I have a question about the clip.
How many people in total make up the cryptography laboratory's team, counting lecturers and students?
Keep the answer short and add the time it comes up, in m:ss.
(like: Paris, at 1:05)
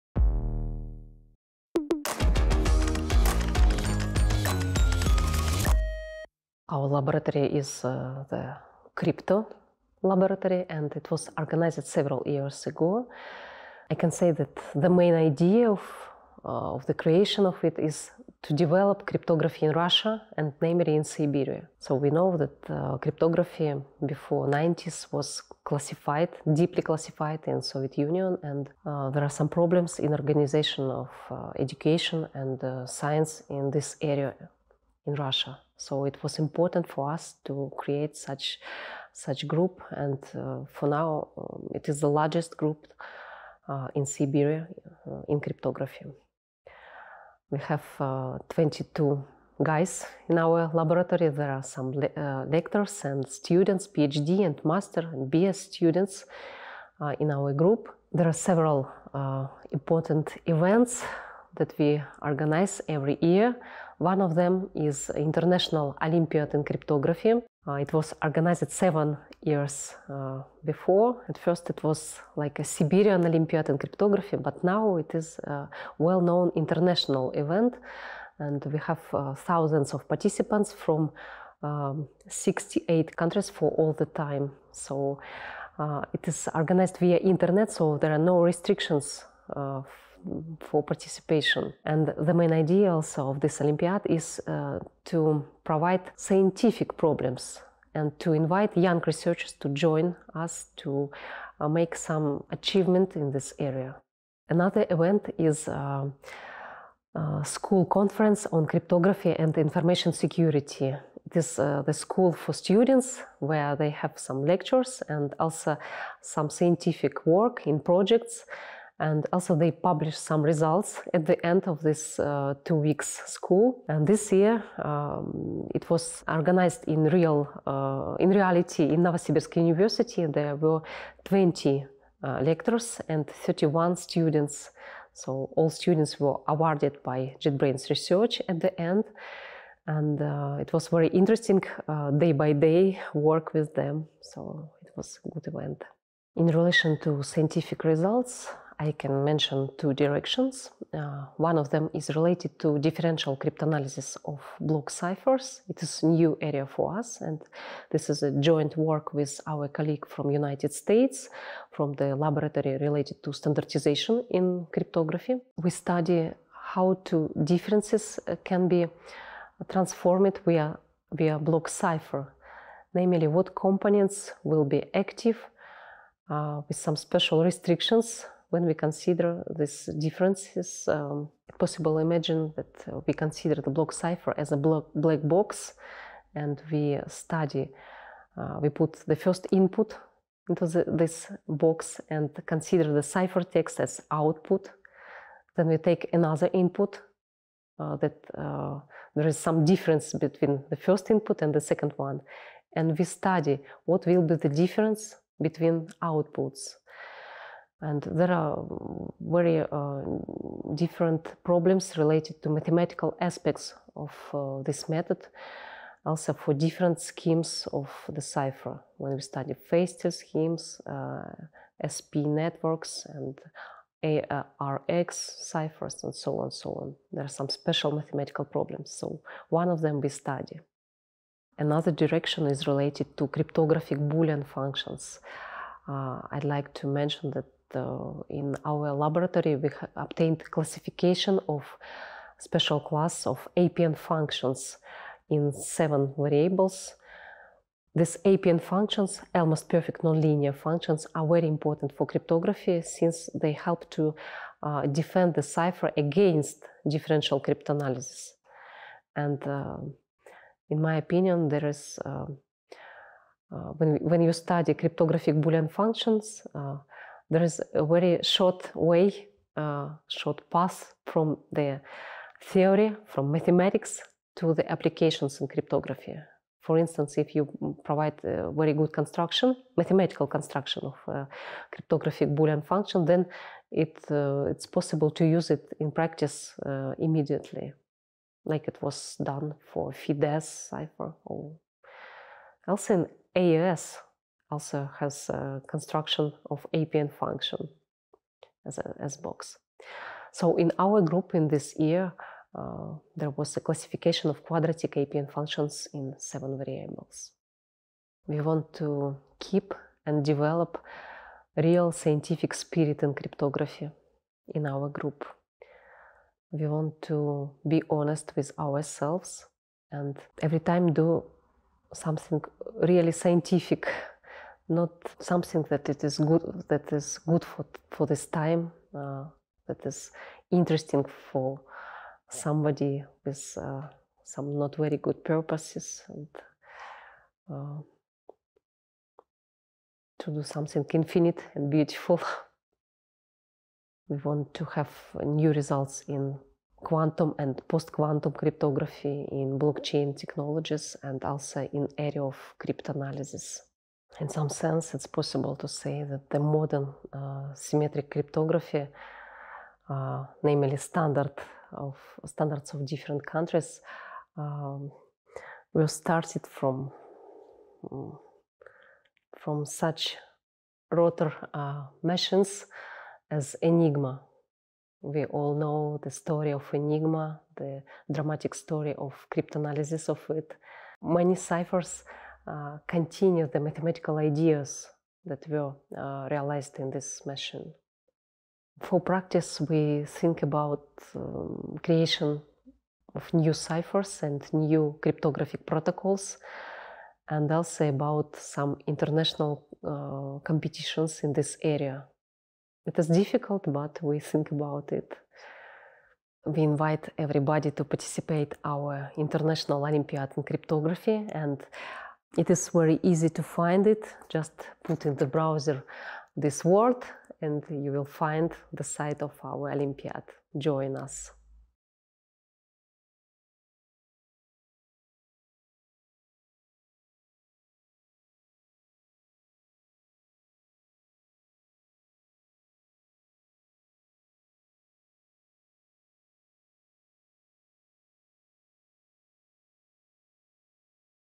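22, at 0:48.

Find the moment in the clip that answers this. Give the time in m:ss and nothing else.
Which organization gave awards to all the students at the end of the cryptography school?
2:17.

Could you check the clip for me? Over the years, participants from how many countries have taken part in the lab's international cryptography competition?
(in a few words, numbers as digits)
68.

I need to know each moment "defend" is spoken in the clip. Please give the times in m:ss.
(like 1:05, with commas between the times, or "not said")
4:14.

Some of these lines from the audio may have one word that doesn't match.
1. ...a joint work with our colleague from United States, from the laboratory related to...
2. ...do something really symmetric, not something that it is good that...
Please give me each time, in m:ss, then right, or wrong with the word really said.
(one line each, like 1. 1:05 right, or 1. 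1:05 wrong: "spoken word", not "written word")
1. 2:38 right
2. 5:20 wrong: "scientific", not "symmetric".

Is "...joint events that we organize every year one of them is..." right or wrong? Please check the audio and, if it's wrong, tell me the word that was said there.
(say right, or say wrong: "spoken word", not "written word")
wrong: "important", not "joint".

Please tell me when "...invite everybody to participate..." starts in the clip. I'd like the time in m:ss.
6:46.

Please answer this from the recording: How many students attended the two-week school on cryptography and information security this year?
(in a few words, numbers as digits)
31.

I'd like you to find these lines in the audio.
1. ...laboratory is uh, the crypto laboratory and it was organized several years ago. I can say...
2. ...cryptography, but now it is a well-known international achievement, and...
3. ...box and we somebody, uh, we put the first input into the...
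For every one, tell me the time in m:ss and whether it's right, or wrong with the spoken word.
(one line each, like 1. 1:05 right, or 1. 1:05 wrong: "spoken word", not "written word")
1. 0:06 right
2. 1:13 wrong: "event", not "achievement"
3. 3:05 wrong: "study", not "somebody".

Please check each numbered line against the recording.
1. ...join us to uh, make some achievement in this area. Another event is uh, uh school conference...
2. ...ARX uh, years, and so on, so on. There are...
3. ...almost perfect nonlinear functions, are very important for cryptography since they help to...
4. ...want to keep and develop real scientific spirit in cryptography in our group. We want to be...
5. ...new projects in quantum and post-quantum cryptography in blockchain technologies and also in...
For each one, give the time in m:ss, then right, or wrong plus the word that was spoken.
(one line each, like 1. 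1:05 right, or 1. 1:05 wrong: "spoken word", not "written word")
1. 1:39 right
2. 3:44 wrong: "ciphers", not "years"
3. 4:09 right
4. 5:08 right
5. 5:45 wrong: "results", not "projects".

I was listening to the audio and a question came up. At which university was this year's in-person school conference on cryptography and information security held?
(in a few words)
Novosibirsk University.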